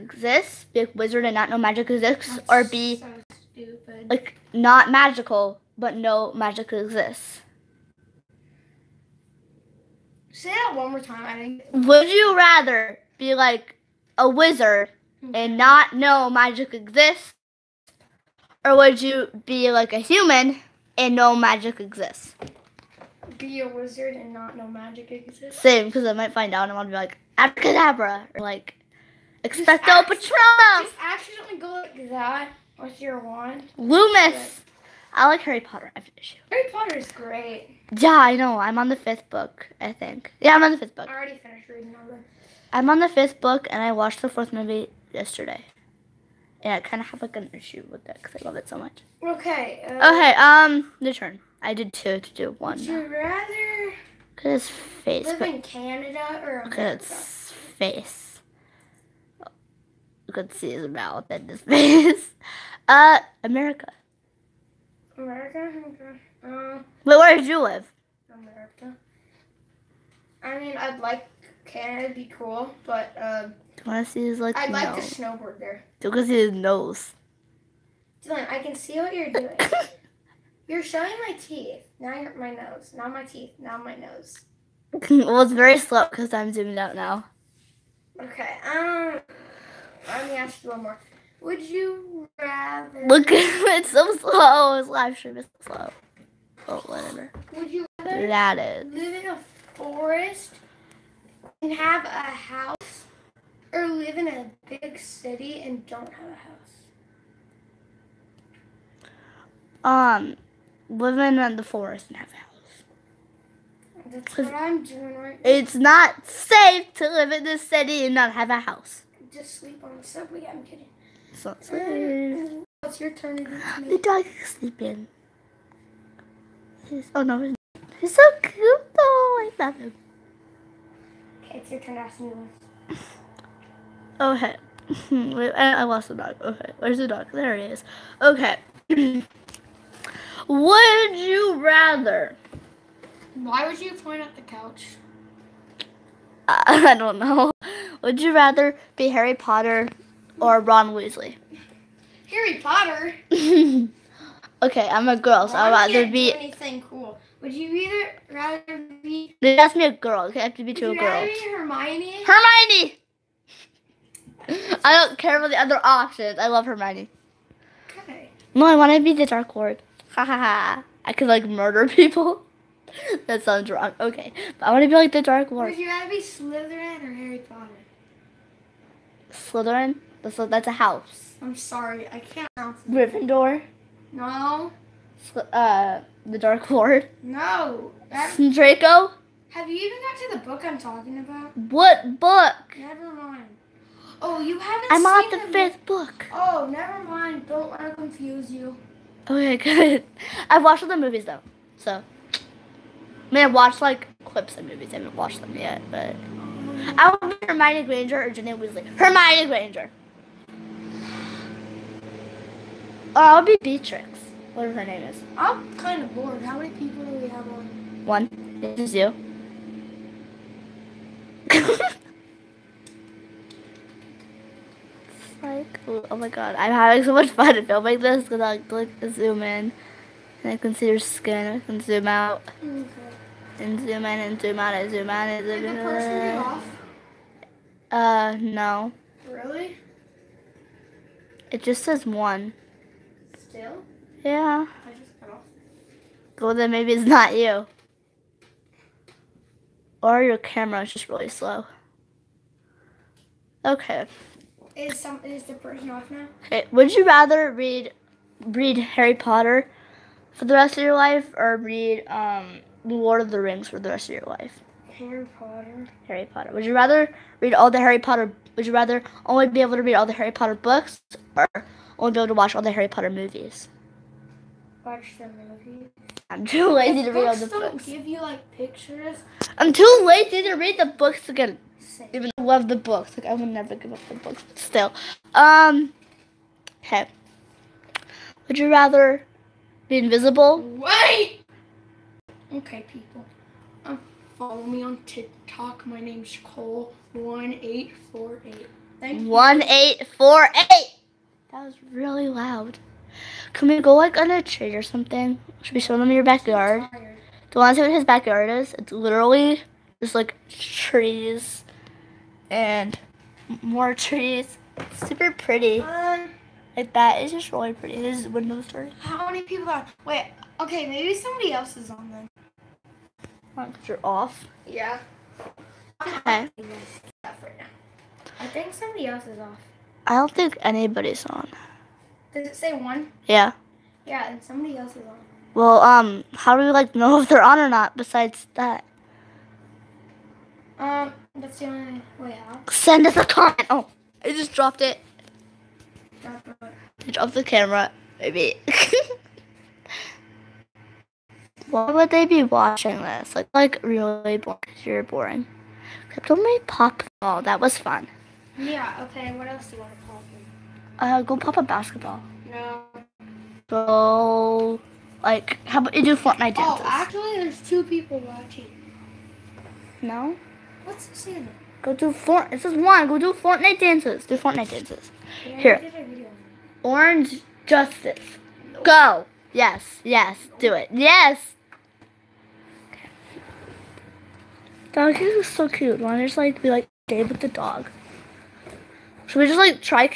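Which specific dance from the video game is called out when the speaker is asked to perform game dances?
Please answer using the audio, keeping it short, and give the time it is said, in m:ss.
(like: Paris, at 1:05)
Orange Justice, at 6:16.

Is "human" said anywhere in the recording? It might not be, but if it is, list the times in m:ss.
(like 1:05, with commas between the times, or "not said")
0:19.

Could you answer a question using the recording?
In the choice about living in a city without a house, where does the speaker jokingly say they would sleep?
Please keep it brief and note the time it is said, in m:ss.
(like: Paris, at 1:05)
The subway, at 2:00.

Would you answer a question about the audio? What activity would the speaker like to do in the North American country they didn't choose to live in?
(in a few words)
Snowboard.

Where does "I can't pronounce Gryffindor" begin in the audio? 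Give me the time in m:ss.
3:02.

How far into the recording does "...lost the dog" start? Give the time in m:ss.
2:15.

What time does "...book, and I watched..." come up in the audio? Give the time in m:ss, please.
0:43.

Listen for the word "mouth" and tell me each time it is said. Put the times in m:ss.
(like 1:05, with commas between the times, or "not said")
1:00.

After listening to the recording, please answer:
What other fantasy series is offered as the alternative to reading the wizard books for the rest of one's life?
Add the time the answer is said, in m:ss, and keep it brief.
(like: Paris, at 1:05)
Lord of the Rings, at 4:22.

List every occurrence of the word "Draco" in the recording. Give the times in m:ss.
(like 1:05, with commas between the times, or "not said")
3:08.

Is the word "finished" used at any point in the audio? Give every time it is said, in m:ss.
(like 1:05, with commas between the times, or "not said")
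0:36, 0:41.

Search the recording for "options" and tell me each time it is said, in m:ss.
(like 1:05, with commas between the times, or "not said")
2:45.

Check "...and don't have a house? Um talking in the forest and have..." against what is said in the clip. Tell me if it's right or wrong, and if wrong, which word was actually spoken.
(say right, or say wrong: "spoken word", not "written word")
wrong: "living", not "talking".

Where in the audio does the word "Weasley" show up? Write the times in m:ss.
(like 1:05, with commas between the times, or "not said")
2:30, 3:28.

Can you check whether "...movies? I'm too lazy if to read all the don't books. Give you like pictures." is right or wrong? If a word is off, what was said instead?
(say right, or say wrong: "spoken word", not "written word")
right.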